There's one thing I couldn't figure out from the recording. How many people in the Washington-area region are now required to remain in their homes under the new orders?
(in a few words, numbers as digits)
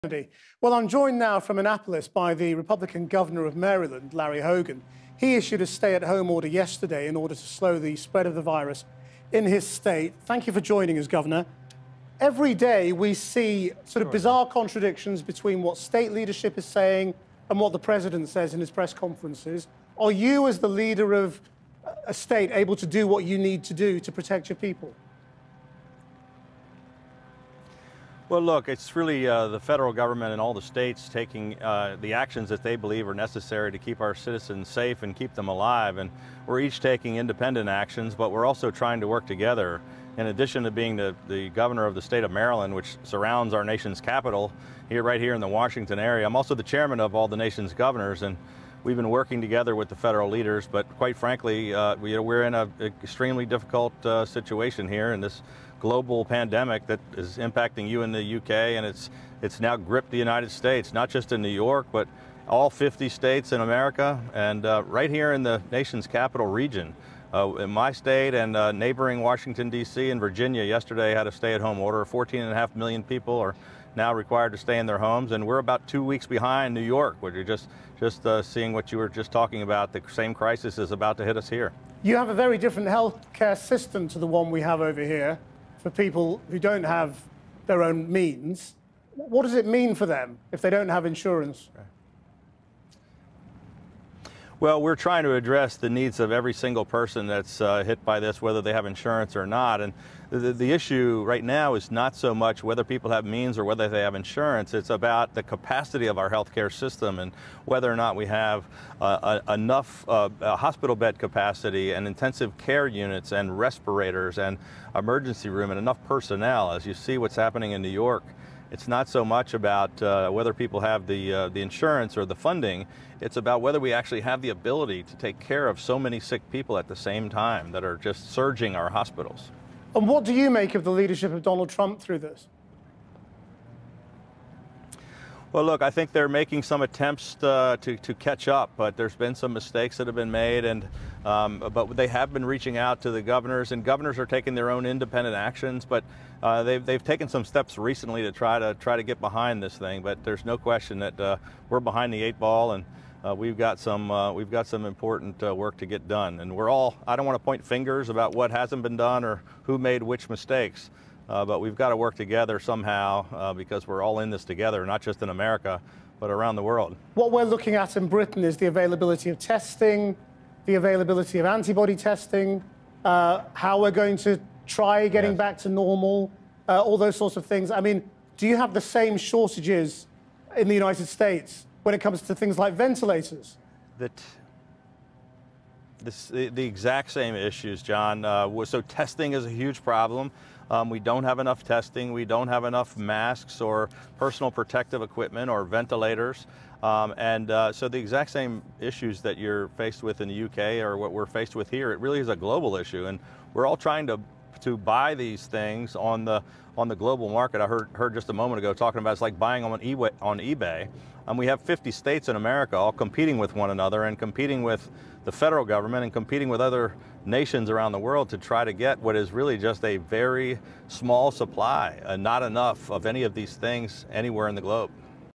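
14.5 million.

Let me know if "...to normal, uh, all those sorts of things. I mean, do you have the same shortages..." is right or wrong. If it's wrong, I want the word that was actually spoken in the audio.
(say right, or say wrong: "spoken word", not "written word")
right.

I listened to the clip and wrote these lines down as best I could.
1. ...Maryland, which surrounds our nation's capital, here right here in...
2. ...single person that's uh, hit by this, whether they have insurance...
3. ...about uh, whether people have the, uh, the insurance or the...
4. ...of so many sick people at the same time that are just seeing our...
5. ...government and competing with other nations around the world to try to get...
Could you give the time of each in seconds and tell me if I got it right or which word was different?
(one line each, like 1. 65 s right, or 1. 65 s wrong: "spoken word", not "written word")
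1. 42 s right
2. 96 s right
3. 119 s right
4. 125 s wrong: "surging", not "seeing"
5. 215 s right.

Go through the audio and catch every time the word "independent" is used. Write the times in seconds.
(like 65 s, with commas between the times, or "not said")
37 s, 144 s.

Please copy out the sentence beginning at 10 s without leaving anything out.
Thank you for joining us, Governor.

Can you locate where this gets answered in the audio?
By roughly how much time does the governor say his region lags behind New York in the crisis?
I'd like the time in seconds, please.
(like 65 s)
75 s.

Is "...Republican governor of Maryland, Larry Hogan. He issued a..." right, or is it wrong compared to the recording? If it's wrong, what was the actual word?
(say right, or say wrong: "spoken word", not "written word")
right.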